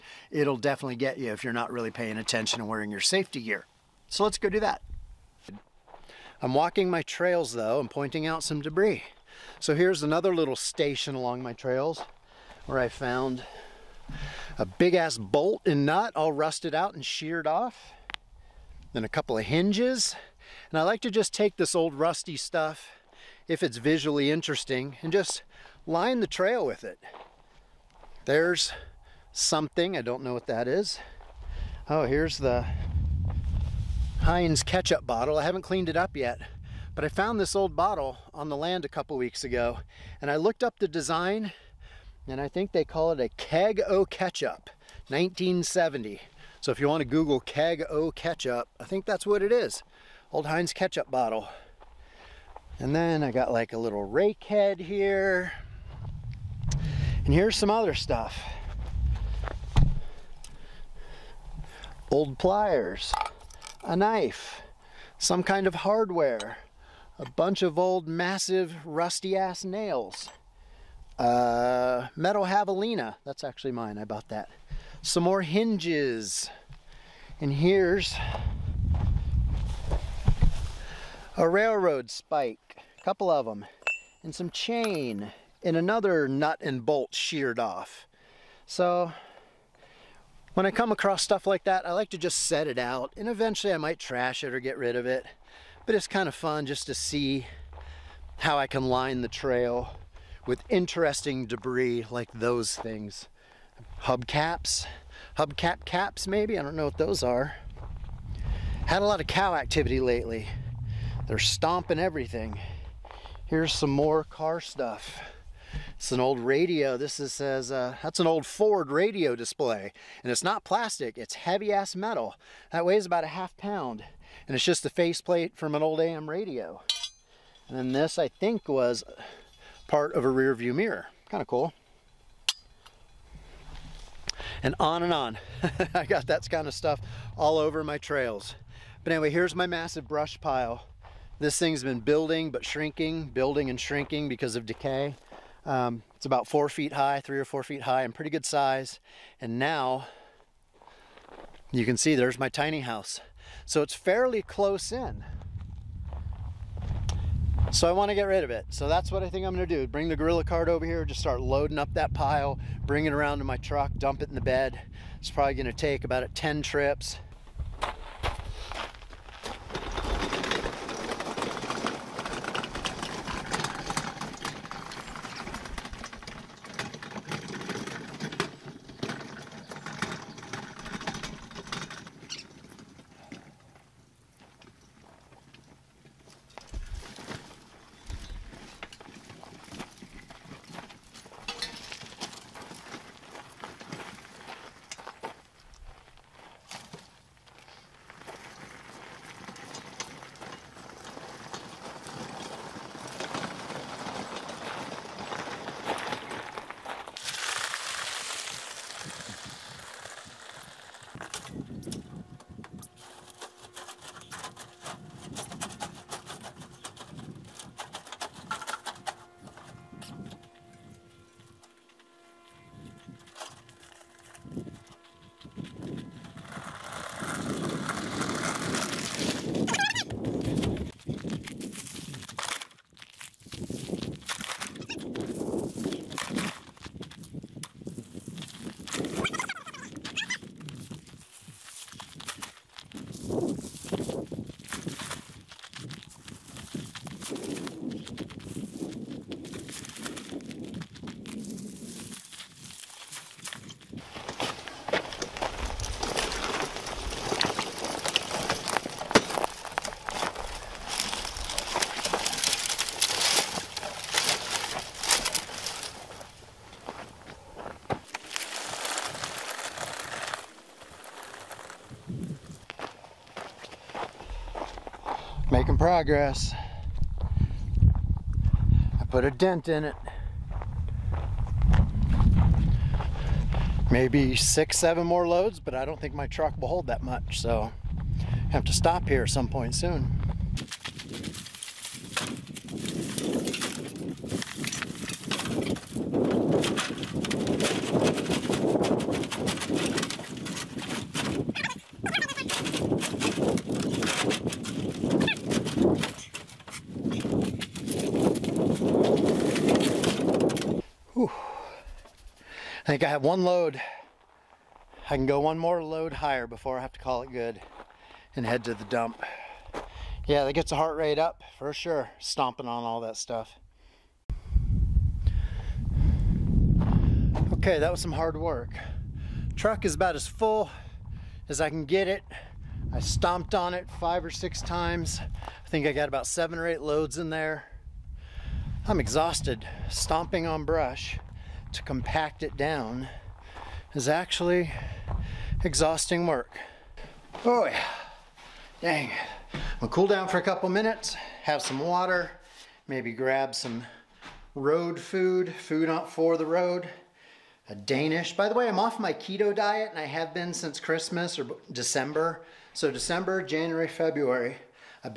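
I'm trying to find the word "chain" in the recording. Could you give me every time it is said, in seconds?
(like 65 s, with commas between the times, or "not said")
84 s.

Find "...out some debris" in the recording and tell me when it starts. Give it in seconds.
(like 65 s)
8 s.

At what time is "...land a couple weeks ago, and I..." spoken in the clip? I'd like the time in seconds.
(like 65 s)
38 s.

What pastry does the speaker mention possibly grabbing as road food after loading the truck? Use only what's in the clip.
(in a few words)
Danish.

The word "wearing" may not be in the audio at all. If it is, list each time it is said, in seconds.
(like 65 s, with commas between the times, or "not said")
2 s.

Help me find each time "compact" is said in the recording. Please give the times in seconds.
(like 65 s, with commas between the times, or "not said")
341 s.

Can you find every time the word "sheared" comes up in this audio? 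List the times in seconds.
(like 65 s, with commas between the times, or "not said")
17 s, 87 s.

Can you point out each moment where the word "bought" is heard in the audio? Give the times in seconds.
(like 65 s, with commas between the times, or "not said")
74 s.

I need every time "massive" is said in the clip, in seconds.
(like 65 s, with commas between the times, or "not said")
68 s, 139 s.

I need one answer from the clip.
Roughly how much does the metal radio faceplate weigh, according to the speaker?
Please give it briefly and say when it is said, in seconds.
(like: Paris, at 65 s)
half pound, at 123 s.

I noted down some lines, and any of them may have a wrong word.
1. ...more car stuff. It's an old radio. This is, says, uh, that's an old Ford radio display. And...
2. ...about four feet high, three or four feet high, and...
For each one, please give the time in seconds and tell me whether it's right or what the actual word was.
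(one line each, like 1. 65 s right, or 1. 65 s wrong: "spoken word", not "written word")
1. 113 s right
2. 146 s right.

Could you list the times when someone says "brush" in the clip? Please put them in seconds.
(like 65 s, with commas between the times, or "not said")
140 s, 340 s.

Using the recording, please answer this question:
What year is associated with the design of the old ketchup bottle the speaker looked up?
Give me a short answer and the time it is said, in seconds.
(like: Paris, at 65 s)
1970, at 45 s.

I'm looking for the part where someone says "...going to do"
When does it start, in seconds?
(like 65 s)
159 s.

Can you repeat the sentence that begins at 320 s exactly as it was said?
Yeah, that gets the heart rate up for sure, stomping on all that stuff.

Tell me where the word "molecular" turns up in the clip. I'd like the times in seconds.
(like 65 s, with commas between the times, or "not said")
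not said.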